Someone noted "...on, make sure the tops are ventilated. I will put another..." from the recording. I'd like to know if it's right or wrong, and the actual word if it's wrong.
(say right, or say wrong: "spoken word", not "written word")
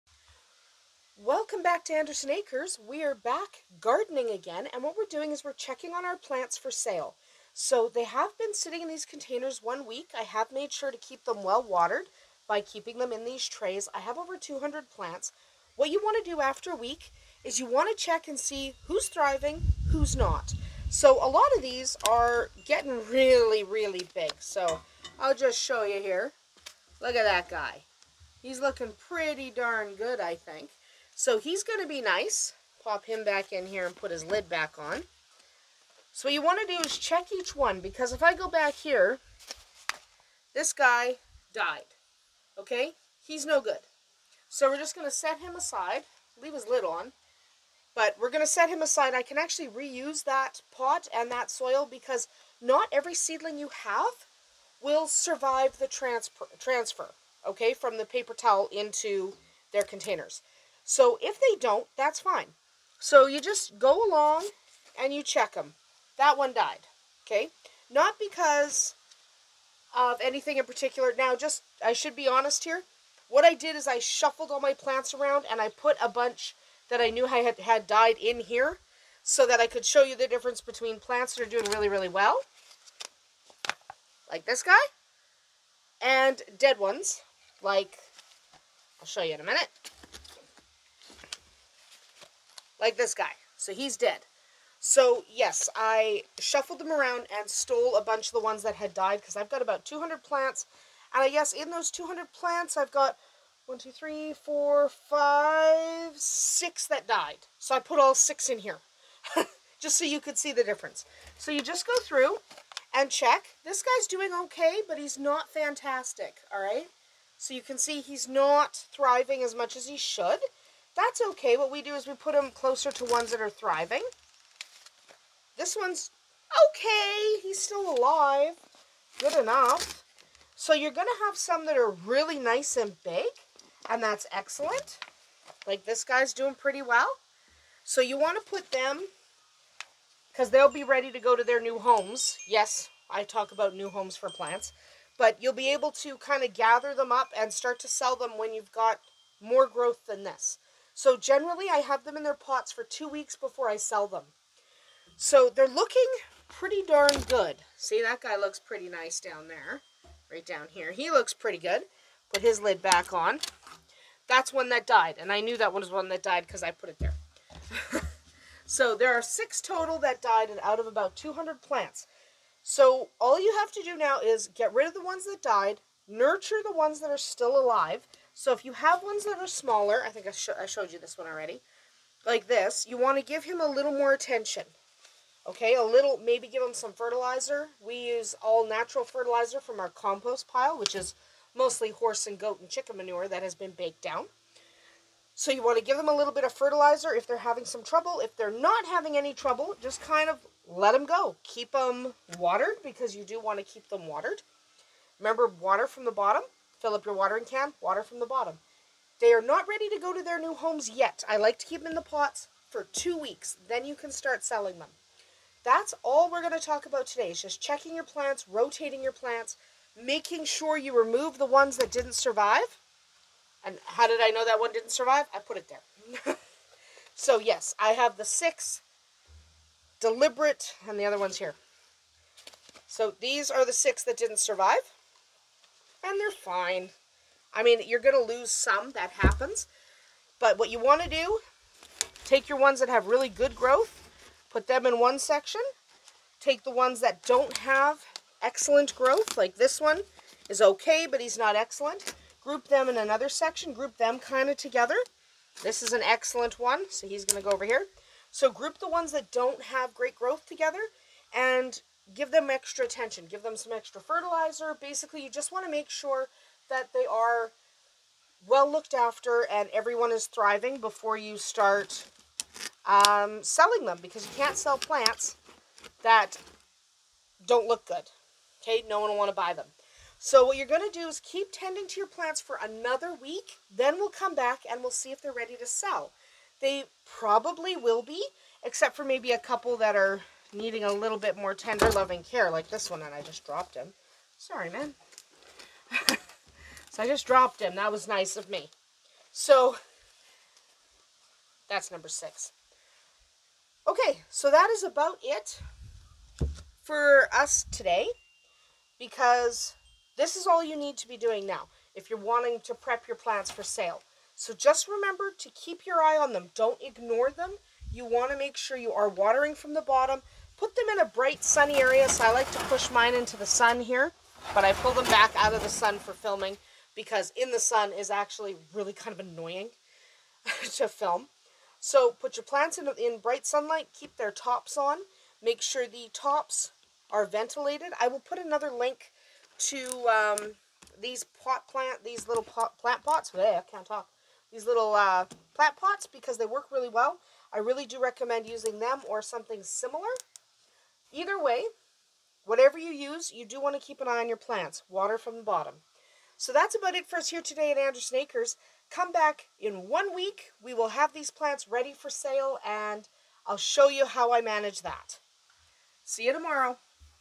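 right.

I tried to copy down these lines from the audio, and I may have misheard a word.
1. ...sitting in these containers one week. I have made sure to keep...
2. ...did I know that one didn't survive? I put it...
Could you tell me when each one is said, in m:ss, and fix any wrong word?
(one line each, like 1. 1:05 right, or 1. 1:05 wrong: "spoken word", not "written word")
1. 0:08 right
2. 3:44 right.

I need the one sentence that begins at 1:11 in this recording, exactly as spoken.
Now, just, I should be honest here.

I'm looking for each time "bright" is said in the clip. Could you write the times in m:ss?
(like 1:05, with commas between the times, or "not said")
5:21, 5:33.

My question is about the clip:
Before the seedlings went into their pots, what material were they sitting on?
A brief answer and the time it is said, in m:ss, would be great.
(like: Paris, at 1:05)
paper towel, at 0:58.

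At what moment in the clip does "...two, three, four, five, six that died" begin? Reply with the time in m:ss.
1:43.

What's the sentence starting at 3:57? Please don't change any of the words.
I mean, you're going to lose some.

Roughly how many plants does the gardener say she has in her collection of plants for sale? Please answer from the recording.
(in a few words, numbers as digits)
200.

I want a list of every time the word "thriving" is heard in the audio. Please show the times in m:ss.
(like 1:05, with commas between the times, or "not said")
0:19, 1:58, 2:03, 4:30.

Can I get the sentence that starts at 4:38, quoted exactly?
Okay, no one will want to buy them.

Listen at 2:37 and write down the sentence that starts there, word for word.
See, that guy looks pretty nice down there, right down here.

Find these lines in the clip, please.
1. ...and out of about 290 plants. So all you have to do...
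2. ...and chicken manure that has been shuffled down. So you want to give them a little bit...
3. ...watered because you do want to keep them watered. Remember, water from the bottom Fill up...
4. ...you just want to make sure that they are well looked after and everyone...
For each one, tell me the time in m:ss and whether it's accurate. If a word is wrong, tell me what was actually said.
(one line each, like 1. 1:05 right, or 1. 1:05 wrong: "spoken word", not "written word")
1. 2:50 wrong: "200", not "290"
2. 3:12 wrong: "baked", not "shuffled"
3. 3:22 right
4. 4:25 right.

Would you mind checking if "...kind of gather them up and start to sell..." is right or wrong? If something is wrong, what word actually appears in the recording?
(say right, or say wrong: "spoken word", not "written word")
right.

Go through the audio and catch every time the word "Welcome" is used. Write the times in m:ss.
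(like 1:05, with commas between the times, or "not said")
0:01.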